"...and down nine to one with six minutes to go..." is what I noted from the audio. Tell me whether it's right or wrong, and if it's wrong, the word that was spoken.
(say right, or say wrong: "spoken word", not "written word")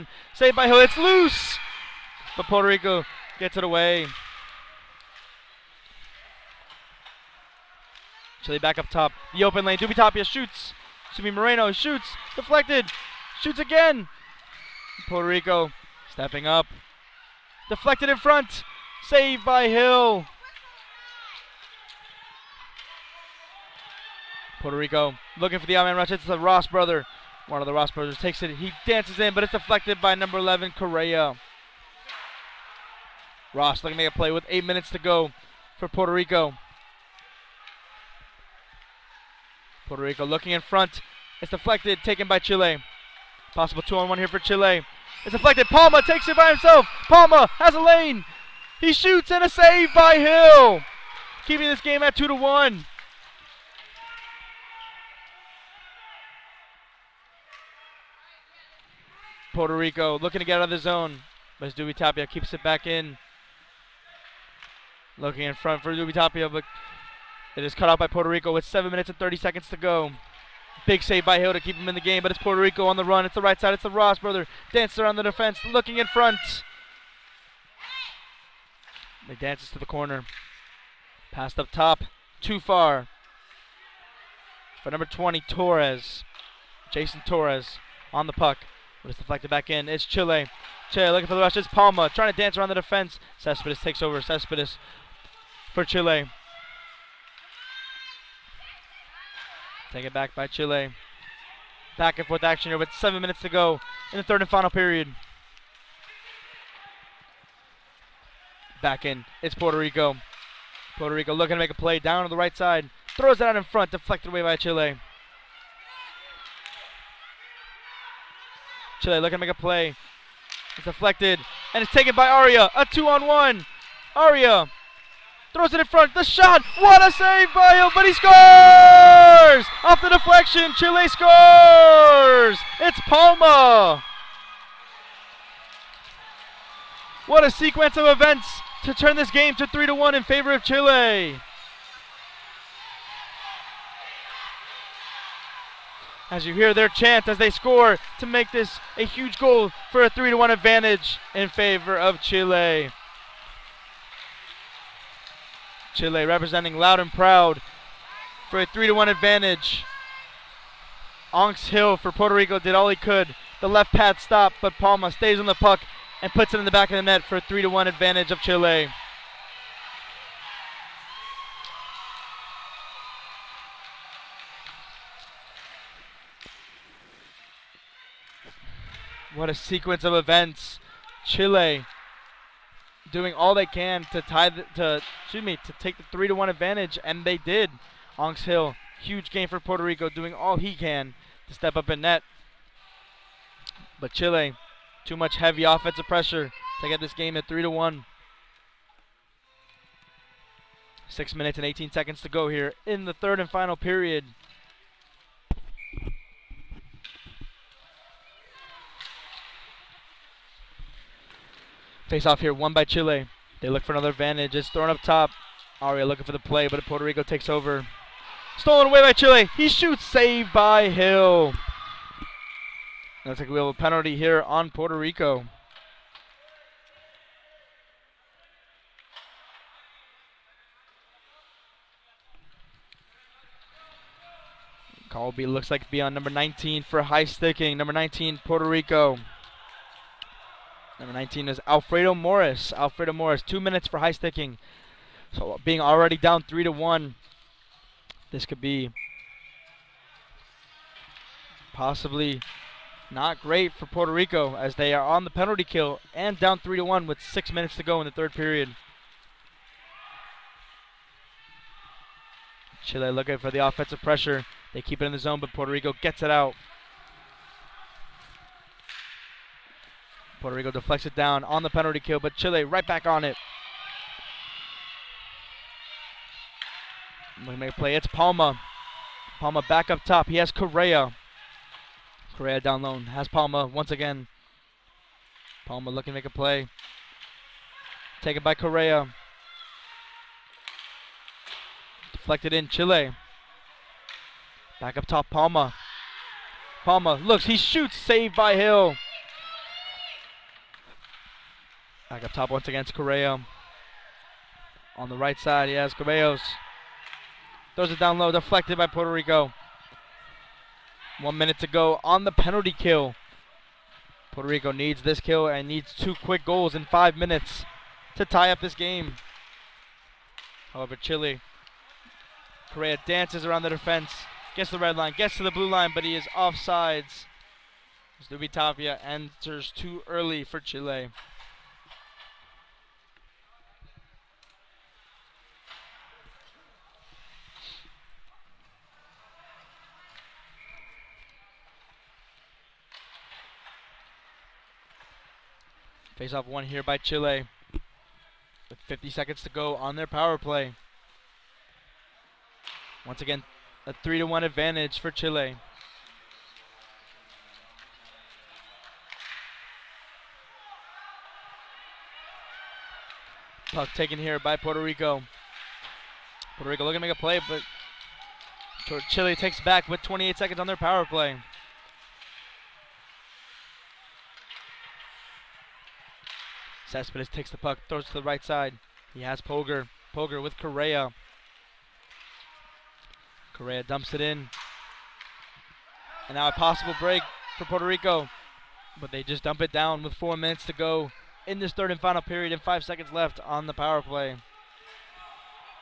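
wrong: "three", not "nine".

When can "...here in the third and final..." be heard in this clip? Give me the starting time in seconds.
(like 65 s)
202 s.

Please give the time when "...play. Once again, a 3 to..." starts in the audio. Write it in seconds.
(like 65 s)
350 s.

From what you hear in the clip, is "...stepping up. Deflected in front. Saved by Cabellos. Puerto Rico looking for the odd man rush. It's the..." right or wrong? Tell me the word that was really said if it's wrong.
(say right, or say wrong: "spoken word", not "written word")
wrong: "Hill", not "Cabellos".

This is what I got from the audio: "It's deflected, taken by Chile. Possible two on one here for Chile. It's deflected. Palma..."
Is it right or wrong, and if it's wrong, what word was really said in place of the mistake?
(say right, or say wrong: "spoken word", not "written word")
right.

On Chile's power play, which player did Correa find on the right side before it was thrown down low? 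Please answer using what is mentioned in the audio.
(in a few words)
Cabellos.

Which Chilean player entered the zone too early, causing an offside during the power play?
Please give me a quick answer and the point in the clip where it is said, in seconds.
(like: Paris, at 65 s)
Zubi Tapia, at 328 s.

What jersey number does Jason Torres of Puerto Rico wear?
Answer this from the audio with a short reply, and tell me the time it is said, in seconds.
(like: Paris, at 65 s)
20, at 84 s.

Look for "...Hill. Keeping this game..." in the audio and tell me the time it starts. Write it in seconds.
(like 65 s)
50 s.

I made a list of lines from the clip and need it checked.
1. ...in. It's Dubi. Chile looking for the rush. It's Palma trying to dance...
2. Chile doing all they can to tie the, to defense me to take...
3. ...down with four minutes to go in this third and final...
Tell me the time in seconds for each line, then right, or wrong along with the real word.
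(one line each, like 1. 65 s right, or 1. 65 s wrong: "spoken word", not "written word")
1. 89 s wrong: "Chile", not "Dubi"
2. 181 s wrong: "excuse", not "defense"
3. 389 s right.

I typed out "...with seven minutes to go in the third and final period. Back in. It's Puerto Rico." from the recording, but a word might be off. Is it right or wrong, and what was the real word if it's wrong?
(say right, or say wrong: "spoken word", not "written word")
right.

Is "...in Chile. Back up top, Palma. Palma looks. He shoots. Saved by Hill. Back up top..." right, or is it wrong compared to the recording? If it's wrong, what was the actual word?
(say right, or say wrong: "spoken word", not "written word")
right.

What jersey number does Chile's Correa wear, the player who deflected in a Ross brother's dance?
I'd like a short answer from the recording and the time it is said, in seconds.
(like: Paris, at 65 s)
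11, at 30 s.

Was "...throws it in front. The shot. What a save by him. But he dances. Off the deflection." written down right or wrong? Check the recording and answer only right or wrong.
wrong.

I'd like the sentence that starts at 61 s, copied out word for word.
But Dubi Tapia keeps it back in.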